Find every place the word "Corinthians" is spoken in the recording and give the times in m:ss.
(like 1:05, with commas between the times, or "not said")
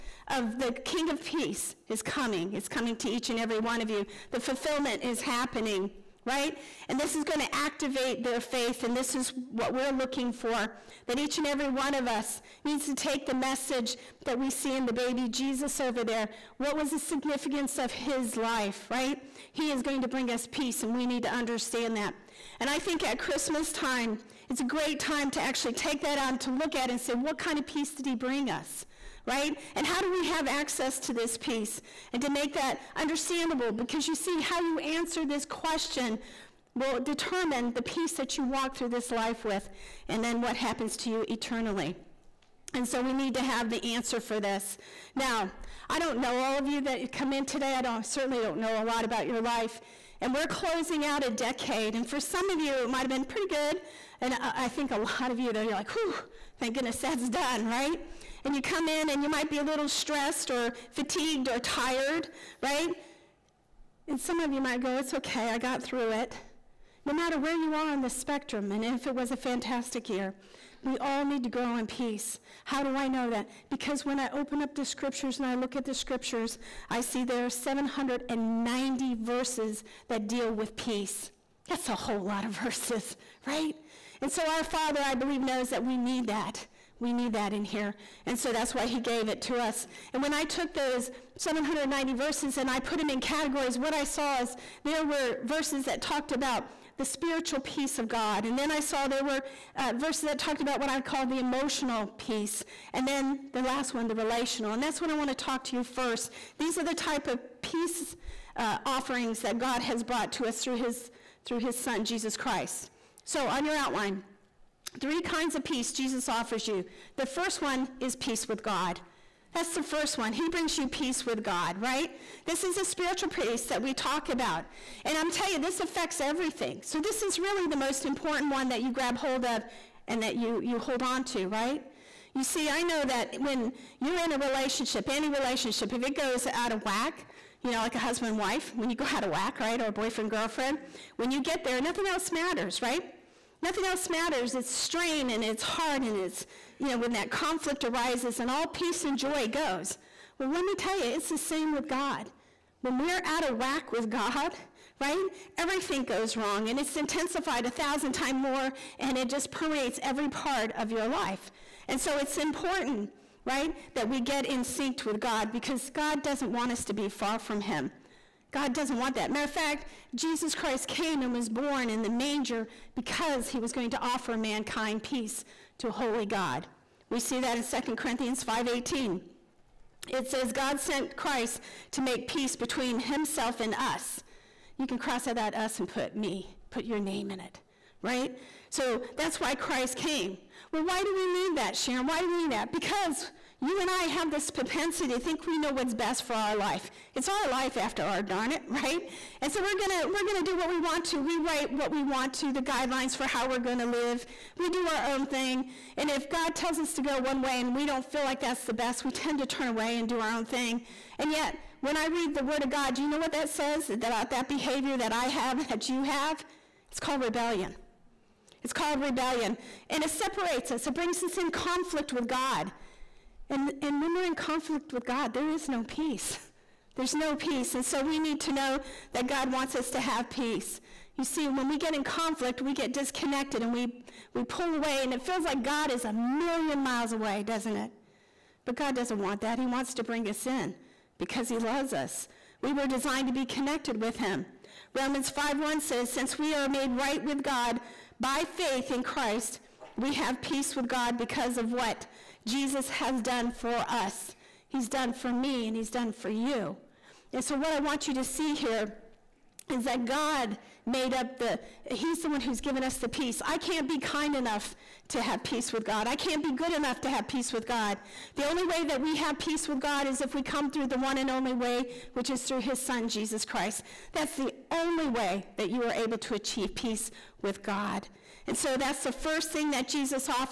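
2:57.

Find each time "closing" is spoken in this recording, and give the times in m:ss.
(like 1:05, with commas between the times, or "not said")
0:50.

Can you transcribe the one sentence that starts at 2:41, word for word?
And so it's important, right, that we get in sync with God because God doesn't want us to be far from Him.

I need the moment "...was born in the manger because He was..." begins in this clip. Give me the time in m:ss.
2:51.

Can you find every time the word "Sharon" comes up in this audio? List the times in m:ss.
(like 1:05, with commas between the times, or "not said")
3:11.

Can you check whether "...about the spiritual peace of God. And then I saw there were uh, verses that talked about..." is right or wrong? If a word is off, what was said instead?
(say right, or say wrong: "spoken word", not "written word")
right.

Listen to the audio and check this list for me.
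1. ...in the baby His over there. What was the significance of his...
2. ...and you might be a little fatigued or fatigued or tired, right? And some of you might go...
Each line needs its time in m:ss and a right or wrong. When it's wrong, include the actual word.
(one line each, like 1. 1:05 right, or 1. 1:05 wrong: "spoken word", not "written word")
1. 0:14 wrong: "Jesus", not "His"
2. 0:59 wrong: "stressed", not "fatigued".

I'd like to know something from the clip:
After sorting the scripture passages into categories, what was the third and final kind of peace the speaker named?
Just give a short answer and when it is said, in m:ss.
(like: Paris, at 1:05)
Relational, at 1:44.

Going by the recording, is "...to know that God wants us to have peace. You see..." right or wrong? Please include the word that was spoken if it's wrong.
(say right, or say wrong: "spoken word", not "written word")
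right.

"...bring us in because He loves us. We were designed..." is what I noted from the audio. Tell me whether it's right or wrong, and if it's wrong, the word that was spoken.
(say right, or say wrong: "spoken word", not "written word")
right.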